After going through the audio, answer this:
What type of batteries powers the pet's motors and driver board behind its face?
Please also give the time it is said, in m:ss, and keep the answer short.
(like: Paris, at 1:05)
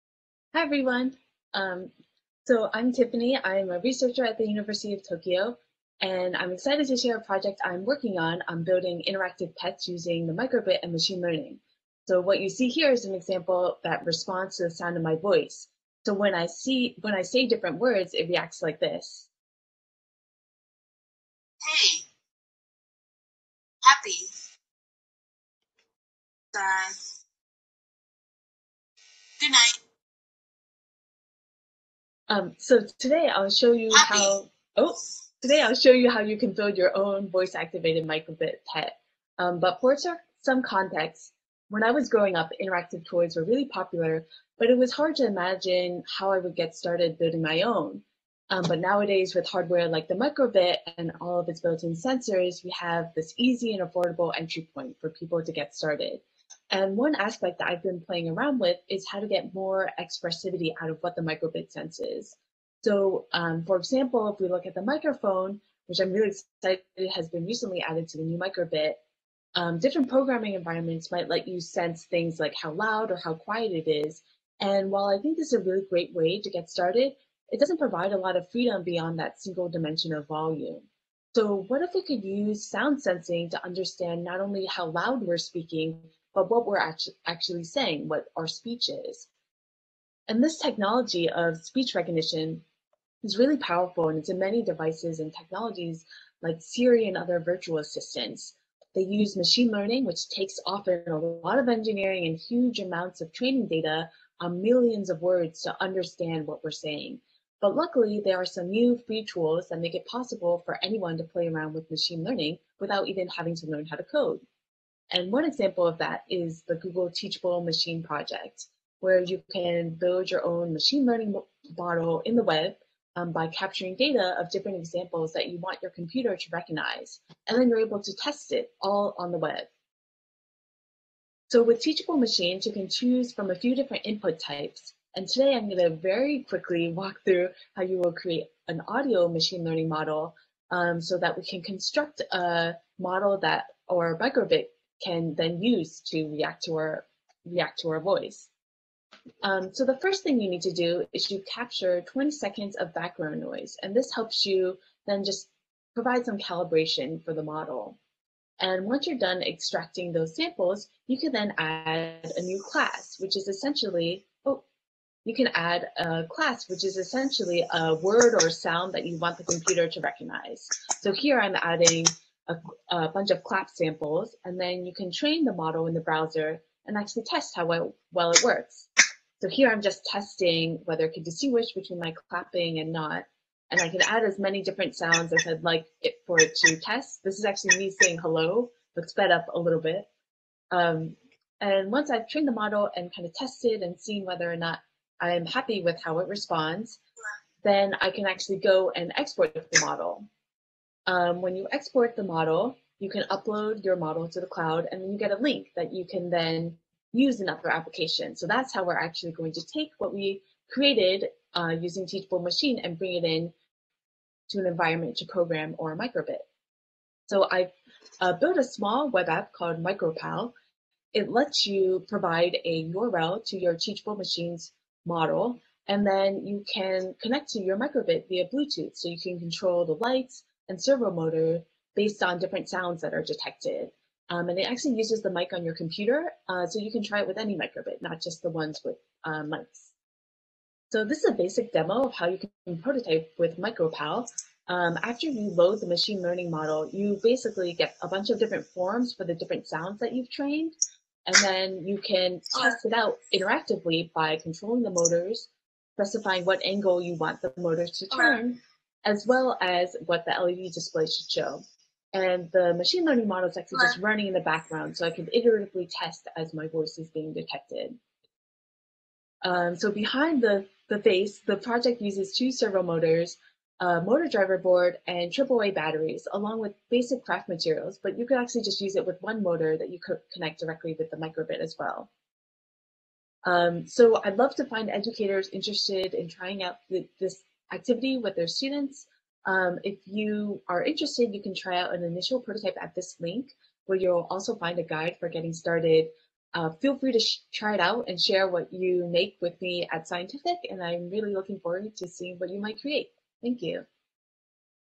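AAA, at 4:35.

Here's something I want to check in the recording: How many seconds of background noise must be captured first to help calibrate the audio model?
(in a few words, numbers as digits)
20.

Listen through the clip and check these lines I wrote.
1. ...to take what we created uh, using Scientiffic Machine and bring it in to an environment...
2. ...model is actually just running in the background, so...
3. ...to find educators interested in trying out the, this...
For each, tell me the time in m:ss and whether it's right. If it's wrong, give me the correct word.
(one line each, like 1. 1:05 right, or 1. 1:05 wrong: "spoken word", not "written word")
1. 3:29 wrong: "Teachable", not "Scientiffic"
2. 4:23 right
3. 4:44 right.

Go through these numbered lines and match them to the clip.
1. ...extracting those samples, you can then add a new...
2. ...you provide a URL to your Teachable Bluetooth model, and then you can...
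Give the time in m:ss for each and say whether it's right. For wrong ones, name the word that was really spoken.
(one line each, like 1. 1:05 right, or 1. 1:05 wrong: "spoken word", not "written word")
1. 2:39 right
2. 3:41 wrong: "Machines", not "Bluetooth".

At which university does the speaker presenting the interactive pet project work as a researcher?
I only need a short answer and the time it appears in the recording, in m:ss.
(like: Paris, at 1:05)
University of Tokyo, at 0:04.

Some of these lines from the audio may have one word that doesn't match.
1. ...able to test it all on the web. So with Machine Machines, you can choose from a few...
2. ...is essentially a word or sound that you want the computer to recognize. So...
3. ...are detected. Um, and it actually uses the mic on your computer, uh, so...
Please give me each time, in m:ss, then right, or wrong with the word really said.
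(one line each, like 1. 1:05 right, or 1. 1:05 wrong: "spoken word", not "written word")
1. 2:07 wrong: "Teachable", not "Machine"
2. 2:46 right
3. 3:53 right.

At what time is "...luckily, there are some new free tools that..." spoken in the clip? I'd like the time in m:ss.
1:47.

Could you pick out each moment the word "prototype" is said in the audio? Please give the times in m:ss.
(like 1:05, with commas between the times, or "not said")
4:02, 4:52.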